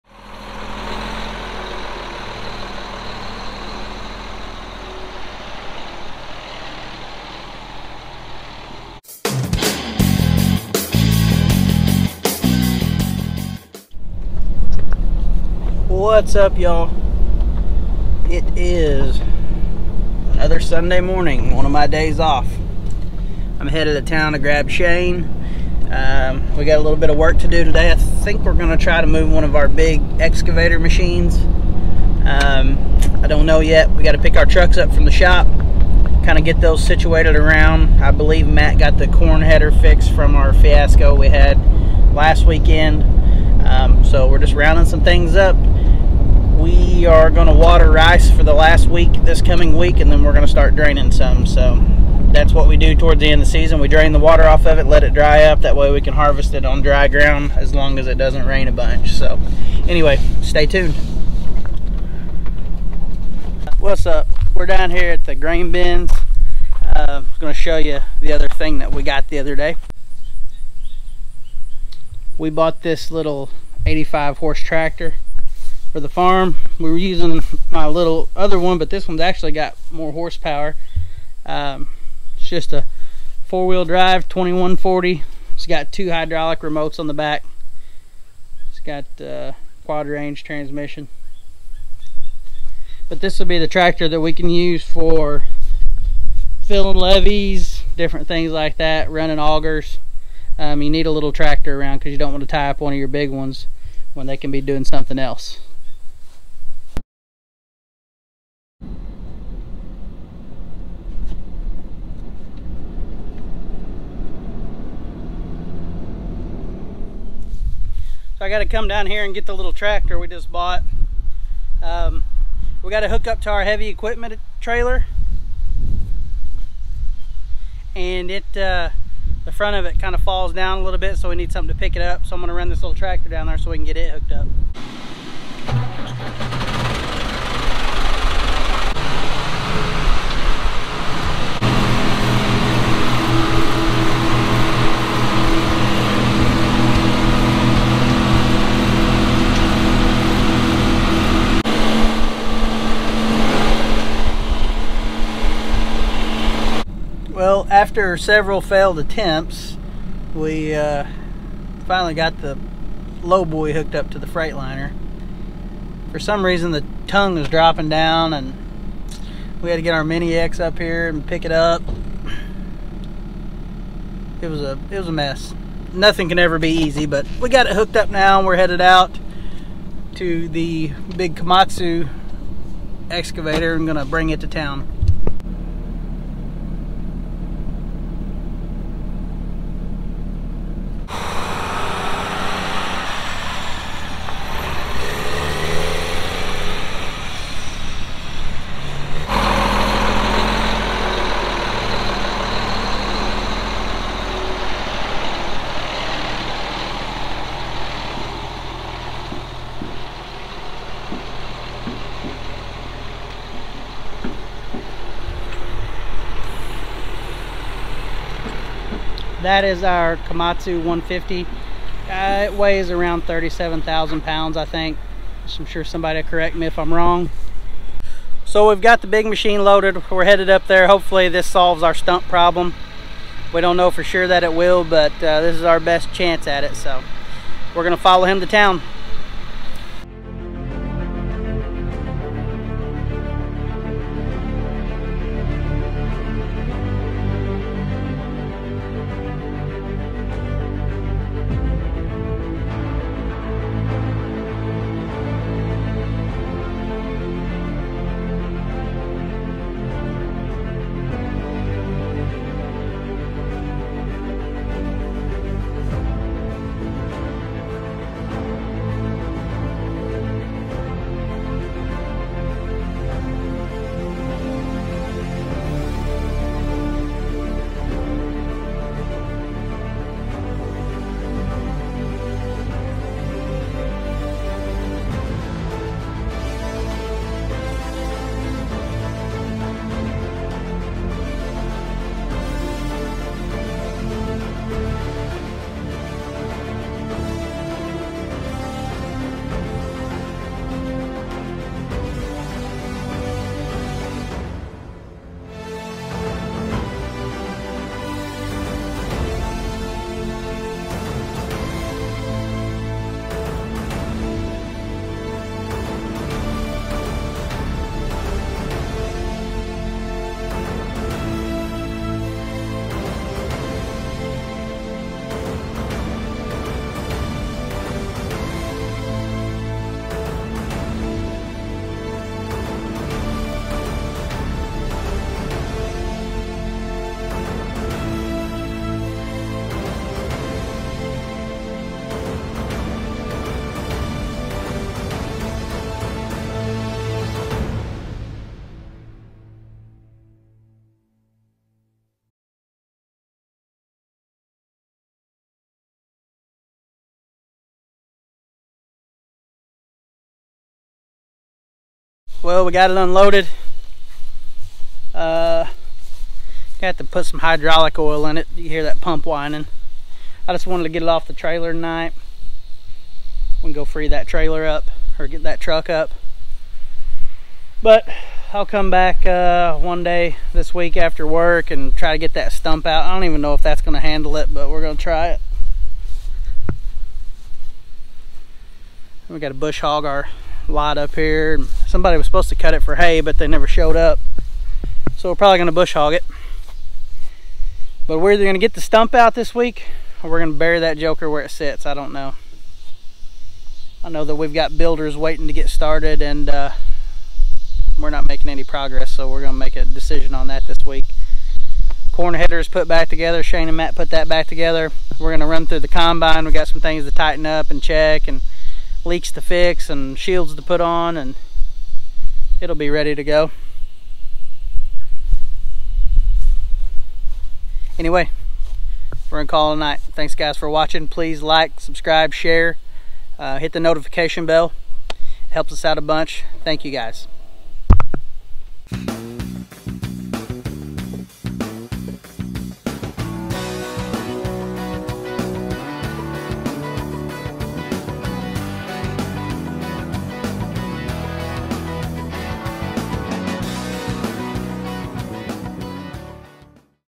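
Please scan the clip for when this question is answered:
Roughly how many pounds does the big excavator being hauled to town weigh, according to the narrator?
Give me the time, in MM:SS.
03:43.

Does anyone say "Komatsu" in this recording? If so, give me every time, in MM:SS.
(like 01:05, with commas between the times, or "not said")
03:01, 03:40.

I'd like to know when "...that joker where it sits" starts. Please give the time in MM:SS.
06:40.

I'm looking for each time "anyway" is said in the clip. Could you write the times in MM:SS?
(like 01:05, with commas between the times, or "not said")
00:59, 07:07.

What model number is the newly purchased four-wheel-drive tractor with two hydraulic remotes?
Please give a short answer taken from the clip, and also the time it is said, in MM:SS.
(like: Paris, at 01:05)
2140, at 01:24.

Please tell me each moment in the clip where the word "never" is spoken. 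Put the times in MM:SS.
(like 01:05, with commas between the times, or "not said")
06:33.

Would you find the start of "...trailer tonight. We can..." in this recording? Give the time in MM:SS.
06:11.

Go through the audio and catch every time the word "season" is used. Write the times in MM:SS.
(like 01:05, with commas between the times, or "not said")
00:53.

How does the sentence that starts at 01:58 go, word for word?
So I got to come down here and get the little tractor we just bought.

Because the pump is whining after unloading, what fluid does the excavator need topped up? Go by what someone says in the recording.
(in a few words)
hydraulic oil.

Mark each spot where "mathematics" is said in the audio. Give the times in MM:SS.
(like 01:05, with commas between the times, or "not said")
not said.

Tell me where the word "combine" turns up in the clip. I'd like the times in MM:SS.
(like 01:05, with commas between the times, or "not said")
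06:55.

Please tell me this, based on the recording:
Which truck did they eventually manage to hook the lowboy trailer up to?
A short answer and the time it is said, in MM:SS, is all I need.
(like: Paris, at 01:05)
Freightliner, at 02:44.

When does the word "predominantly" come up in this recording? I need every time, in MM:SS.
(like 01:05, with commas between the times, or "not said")
not said.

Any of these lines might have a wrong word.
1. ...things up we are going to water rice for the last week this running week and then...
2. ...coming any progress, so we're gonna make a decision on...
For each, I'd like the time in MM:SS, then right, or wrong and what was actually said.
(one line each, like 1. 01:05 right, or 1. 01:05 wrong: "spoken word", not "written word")
1. 00:45 wrong: "coming", not "running"
2. 06:48 wrong: "making", not "coming".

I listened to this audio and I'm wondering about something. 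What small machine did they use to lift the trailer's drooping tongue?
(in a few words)
Mini X.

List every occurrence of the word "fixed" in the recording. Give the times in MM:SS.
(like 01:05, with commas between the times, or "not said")
00:39.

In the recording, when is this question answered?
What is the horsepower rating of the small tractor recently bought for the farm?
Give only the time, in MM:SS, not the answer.
01:13.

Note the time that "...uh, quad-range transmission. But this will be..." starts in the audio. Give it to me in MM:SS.
01:29.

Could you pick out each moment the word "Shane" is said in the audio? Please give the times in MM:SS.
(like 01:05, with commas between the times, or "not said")
00:24, 06:53.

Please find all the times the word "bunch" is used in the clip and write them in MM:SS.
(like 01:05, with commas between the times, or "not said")
00:58, 07:16.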